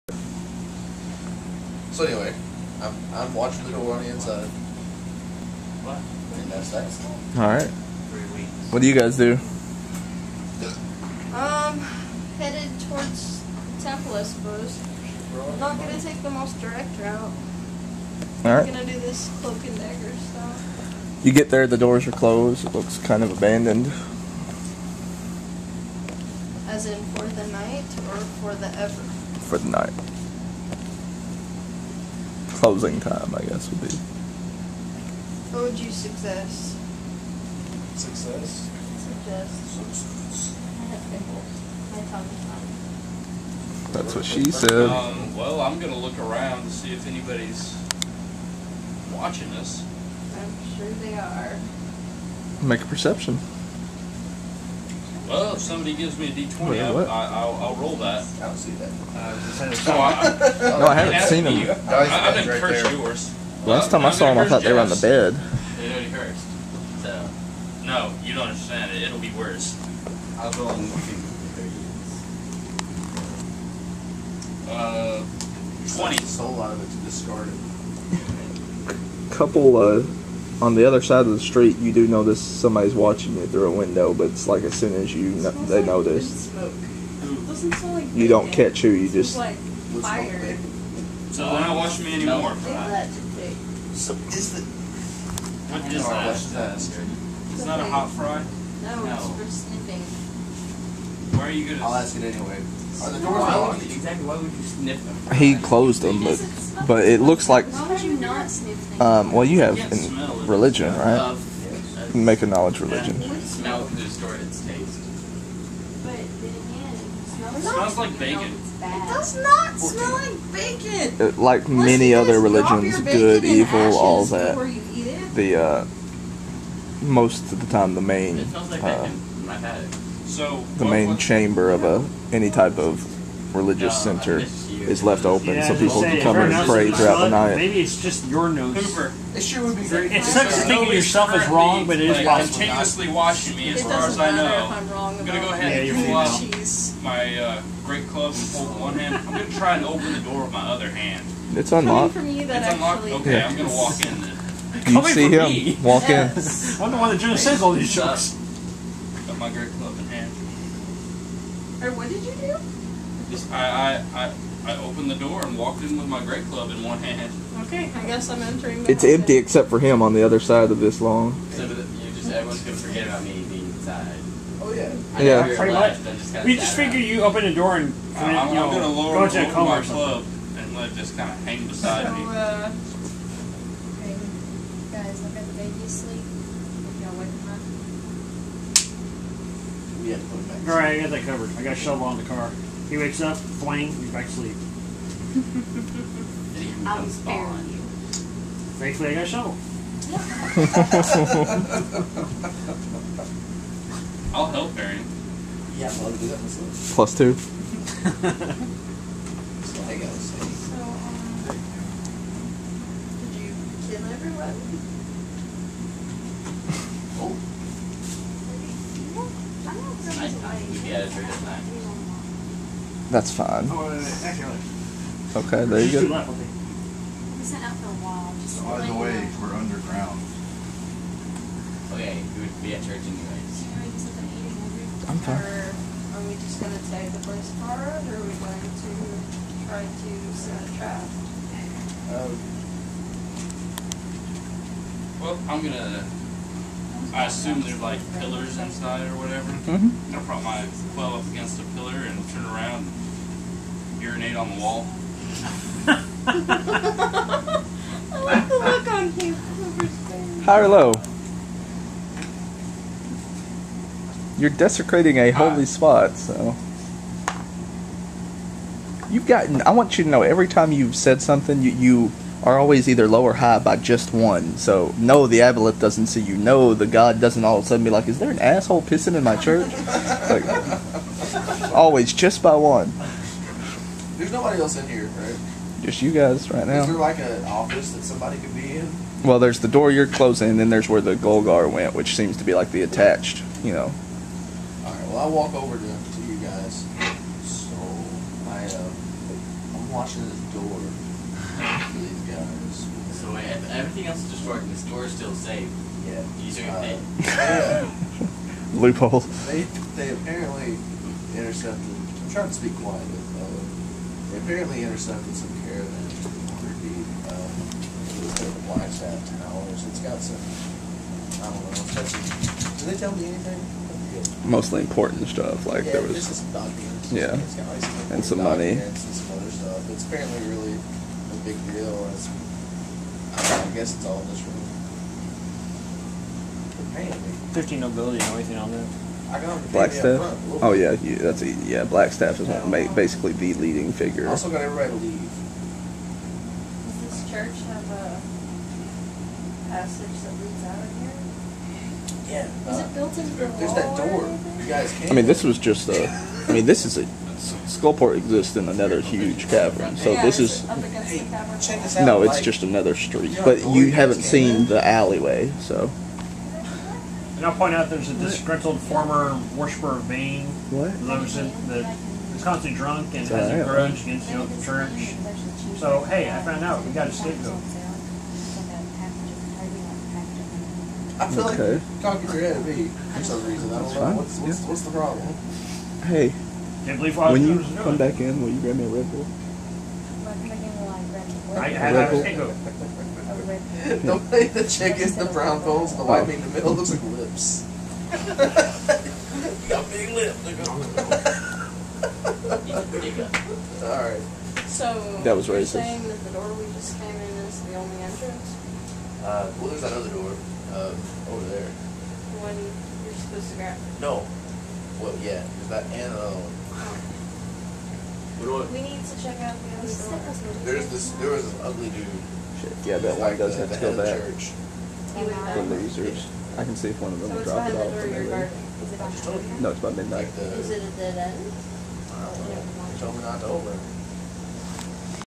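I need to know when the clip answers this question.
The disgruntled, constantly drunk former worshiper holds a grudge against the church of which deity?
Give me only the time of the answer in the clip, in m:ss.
6:10.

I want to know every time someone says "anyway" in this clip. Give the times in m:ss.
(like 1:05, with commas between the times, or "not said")
0:02, 1:42, 3:53.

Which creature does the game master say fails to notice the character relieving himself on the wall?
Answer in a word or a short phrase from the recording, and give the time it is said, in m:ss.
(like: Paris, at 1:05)
aboleth, at 4:35.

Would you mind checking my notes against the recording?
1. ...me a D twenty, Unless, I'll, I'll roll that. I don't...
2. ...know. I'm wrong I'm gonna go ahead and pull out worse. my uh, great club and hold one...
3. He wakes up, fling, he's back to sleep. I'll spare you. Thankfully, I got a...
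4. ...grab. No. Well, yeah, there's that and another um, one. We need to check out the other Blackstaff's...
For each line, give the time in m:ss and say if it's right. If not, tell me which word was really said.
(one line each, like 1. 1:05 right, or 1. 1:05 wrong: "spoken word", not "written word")
1. 0:56 wrong: "Wait", not "Unless"
2. 2:24 wrong: "cheese", not "worse"
3. 3:12 right
4. 6:53 wrong: "There", not "Blackstaff".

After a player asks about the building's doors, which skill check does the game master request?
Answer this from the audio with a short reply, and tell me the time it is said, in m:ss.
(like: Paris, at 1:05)
knowledge religion, at 1:52.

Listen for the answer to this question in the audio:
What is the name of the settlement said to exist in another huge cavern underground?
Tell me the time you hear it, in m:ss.
5:57.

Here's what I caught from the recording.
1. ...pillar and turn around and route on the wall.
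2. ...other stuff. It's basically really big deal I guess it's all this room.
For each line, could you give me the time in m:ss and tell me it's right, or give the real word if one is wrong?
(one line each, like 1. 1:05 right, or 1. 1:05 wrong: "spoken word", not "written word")
1. 4:11 wrong: "urinate", not "route"
2. 5:29 wrong: "apparently", not "basically".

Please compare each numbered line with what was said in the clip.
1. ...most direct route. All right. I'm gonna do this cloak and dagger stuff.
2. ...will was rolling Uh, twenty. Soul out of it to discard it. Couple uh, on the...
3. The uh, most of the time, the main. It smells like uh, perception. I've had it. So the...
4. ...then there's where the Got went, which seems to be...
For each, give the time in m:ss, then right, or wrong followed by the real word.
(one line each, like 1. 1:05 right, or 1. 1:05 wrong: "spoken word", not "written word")
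1. 0:16 right
2. 1:10 right
3. 2:05 wrong: "bacon", not "perception"
4. 4:50 wrong: "Golgar", not "Got".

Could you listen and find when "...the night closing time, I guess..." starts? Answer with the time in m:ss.
0:29.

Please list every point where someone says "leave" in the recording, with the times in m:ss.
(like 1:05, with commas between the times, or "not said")
5:44.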